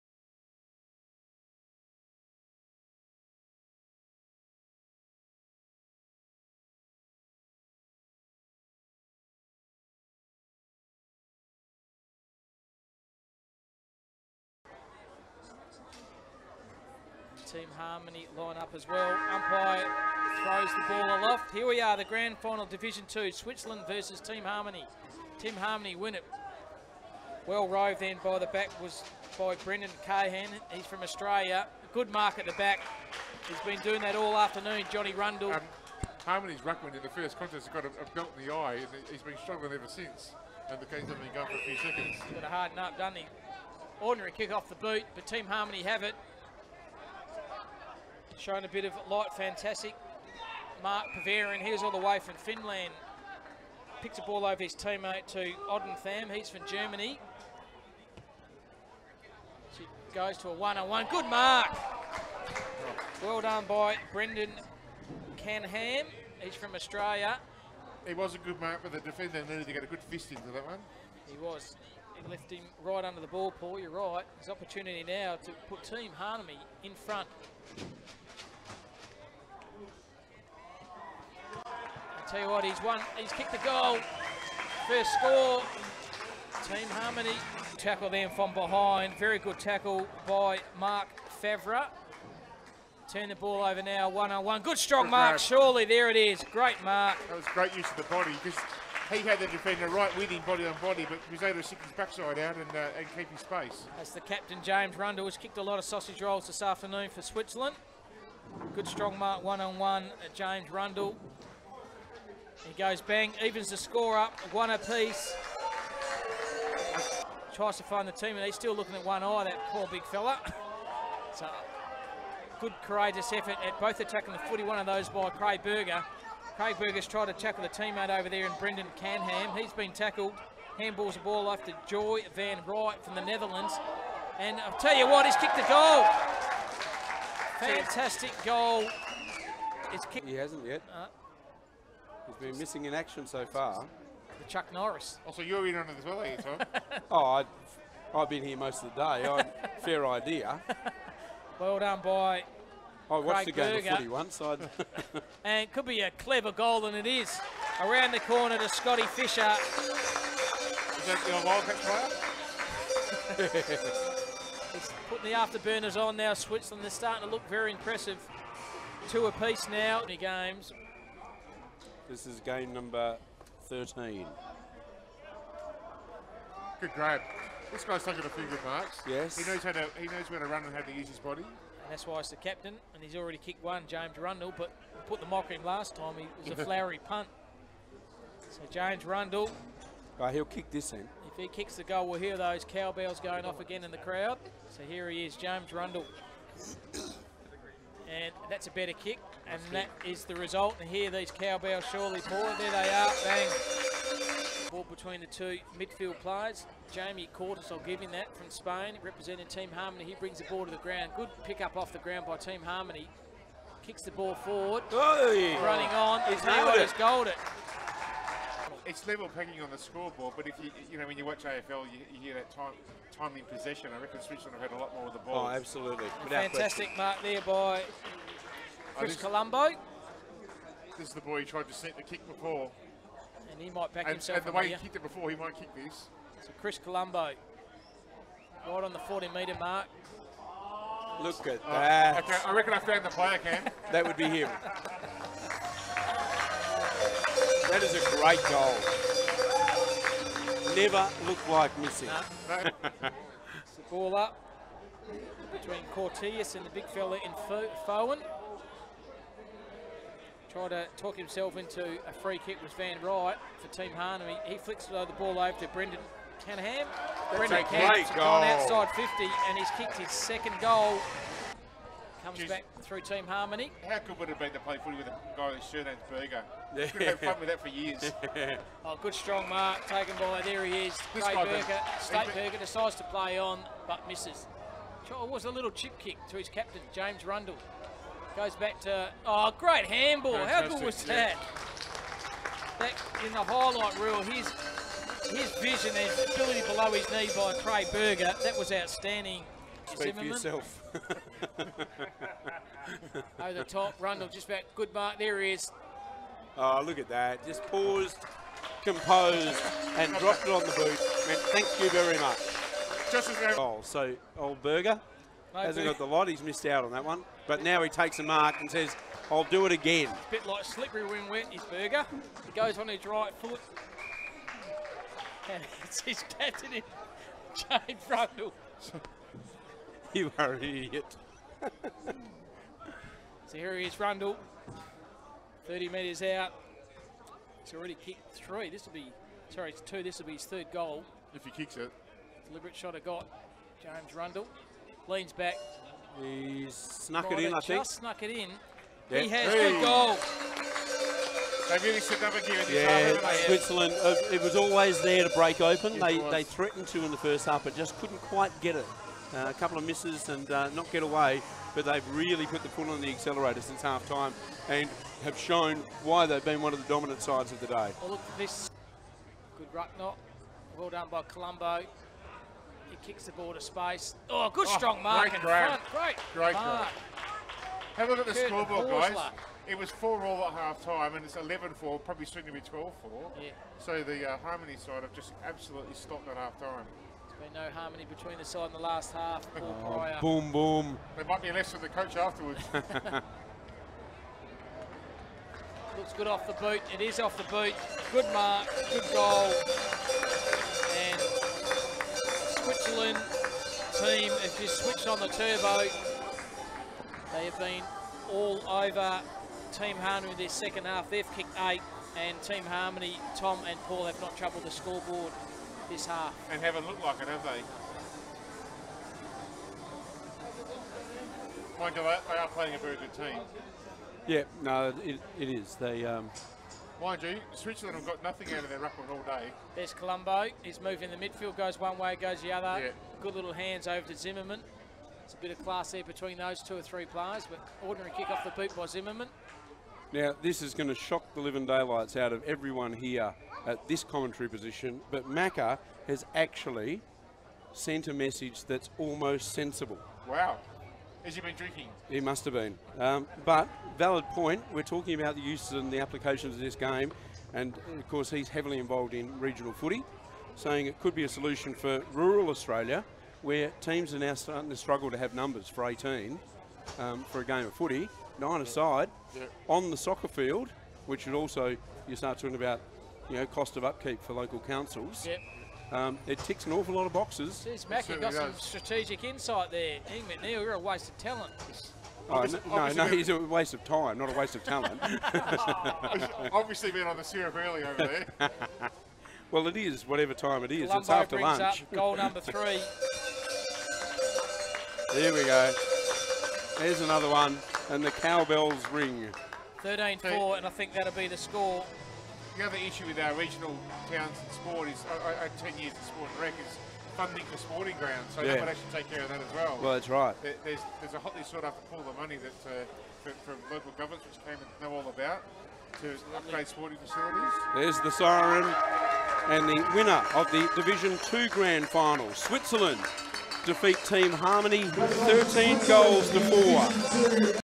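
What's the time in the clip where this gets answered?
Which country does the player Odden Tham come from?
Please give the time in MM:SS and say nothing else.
00:56.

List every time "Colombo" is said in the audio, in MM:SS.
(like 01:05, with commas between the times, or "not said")
03:49, 03:56, 06:11, 07:09, 08:10.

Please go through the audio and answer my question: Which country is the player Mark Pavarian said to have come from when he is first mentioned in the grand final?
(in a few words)
Finland.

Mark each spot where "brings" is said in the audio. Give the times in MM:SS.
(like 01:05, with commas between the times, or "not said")
03:30.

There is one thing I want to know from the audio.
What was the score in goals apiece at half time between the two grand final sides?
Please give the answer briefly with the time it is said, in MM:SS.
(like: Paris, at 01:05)
4 all, at 06:19.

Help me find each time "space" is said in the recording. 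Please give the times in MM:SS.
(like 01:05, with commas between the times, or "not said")
01:43, 06:13.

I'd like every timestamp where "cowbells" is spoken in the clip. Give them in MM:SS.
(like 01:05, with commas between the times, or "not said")
03:12, 03:21, 08:18.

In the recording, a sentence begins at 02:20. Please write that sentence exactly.
Uh, He's been missing in action so far.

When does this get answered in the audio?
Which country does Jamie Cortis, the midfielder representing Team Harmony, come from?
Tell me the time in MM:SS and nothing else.
03:28.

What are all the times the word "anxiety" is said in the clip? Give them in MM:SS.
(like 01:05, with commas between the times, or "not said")
not said.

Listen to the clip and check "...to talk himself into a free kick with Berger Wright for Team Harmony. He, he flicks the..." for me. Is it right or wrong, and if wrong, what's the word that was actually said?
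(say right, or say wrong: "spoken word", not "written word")
wrong: "Van", not "Berger".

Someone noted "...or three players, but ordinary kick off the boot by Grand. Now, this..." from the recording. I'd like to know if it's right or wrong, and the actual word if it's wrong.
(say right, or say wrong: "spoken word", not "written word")
wrong: "Zimmerman", not "Grand".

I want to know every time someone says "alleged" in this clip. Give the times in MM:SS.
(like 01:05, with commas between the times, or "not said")
not said.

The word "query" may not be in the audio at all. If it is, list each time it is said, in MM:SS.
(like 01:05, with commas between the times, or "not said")
not said.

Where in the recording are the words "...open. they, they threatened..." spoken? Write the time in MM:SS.
05:55.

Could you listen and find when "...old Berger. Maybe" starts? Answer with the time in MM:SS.
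05:14.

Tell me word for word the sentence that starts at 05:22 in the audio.
He goes on his right foot.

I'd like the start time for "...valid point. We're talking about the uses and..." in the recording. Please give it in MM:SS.
07:33.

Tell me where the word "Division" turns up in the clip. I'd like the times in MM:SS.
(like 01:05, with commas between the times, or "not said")
00:22, 08:40.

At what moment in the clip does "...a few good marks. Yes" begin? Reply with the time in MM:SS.
02:58.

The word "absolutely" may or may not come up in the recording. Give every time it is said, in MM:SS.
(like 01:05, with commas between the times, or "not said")
03:45, 06:25.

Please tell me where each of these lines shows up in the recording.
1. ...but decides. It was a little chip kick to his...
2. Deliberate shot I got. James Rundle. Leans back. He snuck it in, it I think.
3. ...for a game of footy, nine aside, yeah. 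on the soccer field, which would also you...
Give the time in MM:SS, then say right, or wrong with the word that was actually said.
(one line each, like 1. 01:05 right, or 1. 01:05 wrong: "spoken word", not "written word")
1. 04:43 wrong: "misses", not "decides"
2. 05:42 right
3. 07:47 right.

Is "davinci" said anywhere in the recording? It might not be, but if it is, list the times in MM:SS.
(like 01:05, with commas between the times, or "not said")
not said.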